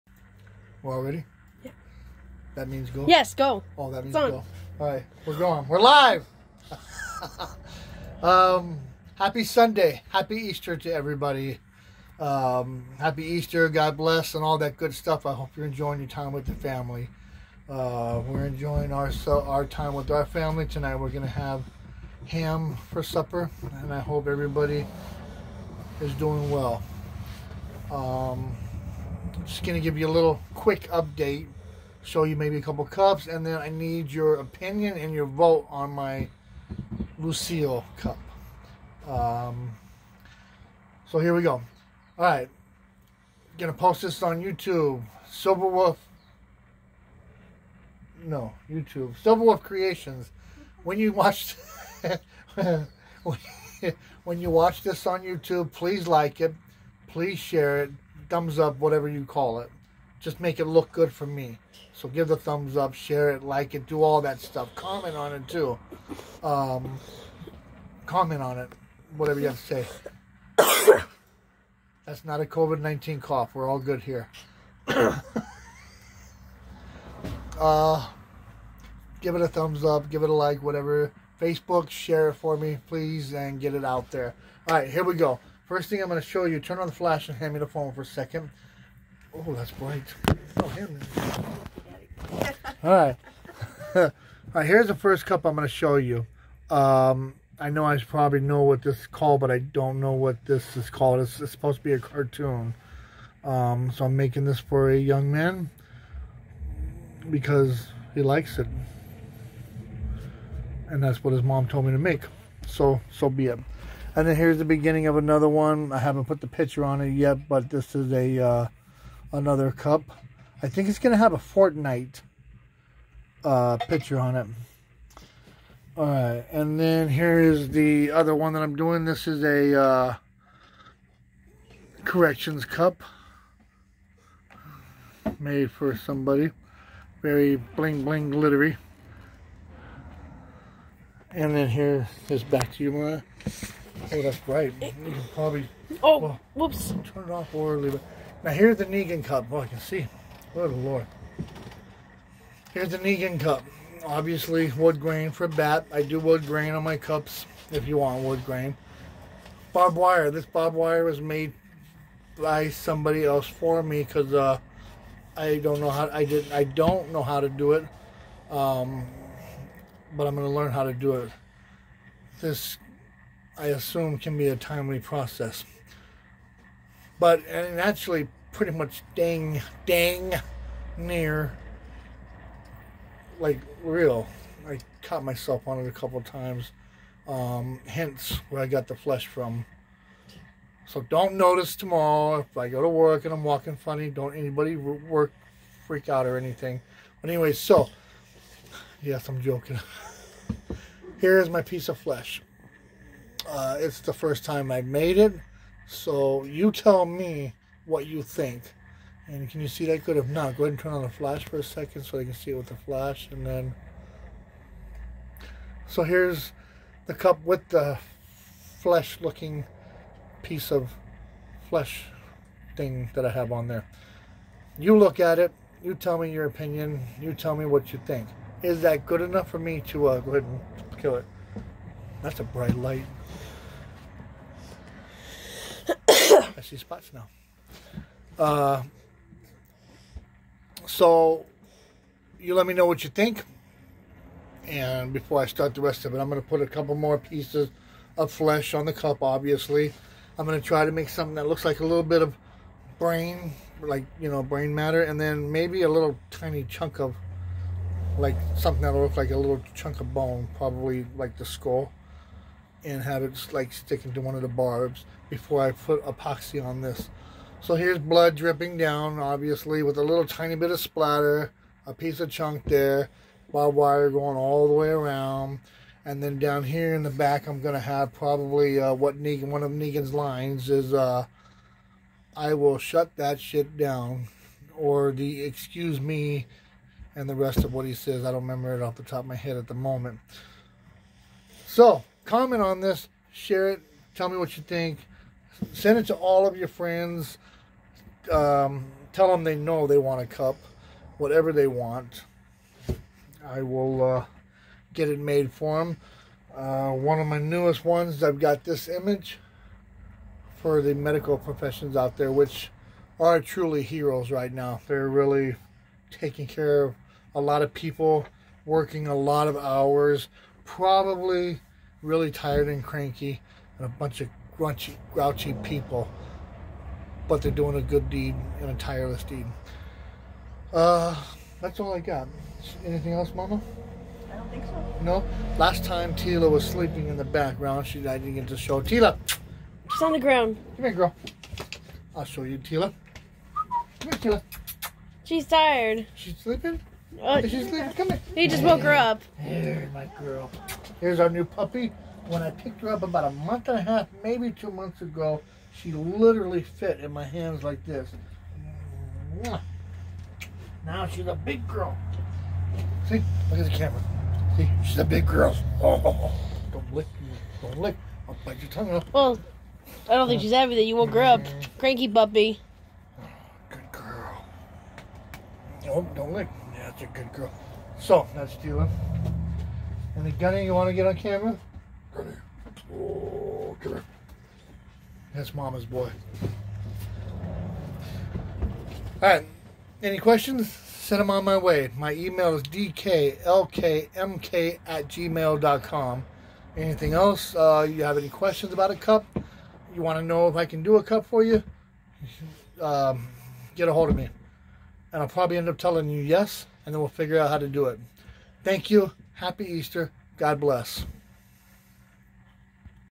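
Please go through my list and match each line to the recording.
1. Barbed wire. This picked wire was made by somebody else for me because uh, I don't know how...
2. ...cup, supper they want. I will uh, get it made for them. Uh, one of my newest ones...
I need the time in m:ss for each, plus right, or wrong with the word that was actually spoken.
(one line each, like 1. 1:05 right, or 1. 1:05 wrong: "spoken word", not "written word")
1. 2:39 wrong: "barbed", not "picked"
2. 5:00 wrong: "whatever", not "supper".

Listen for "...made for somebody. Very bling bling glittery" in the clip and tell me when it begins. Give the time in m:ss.
2:15.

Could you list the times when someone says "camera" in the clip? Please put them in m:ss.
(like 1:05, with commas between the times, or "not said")
6:03, 6:21.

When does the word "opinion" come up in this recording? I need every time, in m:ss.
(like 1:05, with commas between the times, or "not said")
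0:34, 3:46.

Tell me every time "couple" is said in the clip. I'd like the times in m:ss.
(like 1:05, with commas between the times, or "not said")
0:32, 3:05, 4:06.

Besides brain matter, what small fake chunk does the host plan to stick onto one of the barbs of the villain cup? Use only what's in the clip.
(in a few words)
Bone.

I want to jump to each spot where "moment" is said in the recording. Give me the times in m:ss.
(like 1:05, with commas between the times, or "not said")
4:49.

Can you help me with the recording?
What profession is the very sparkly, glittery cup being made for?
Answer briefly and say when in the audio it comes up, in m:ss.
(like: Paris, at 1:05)
Corrections, at 2:12.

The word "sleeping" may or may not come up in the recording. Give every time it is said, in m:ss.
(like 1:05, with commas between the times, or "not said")
5:36, 5:46.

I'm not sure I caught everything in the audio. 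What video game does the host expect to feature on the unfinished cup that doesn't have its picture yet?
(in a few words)
Fortnite.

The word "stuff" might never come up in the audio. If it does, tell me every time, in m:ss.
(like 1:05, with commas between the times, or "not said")
0:14, 1:04.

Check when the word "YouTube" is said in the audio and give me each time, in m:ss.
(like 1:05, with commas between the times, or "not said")
0:44, 0:48, 0:55.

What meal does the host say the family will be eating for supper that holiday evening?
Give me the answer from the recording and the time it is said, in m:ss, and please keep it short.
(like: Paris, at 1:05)
Ham, at 0:22.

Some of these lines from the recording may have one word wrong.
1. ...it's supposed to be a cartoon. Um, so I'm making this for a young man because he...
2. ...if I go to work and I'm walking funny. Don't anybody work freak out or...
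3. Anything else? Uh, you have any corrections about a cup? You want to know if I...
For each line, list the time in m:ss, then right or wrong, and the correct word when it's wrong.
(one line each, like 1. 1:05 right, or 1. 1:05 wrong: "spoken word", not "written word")
1. 1:41 right
2. 3:12 right
3. 6:36 wrong: "questions", not "corrections".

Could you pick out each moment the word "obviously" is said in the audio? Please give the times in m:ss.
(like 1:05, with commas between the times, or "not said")
2:34, 4:09, 4:29.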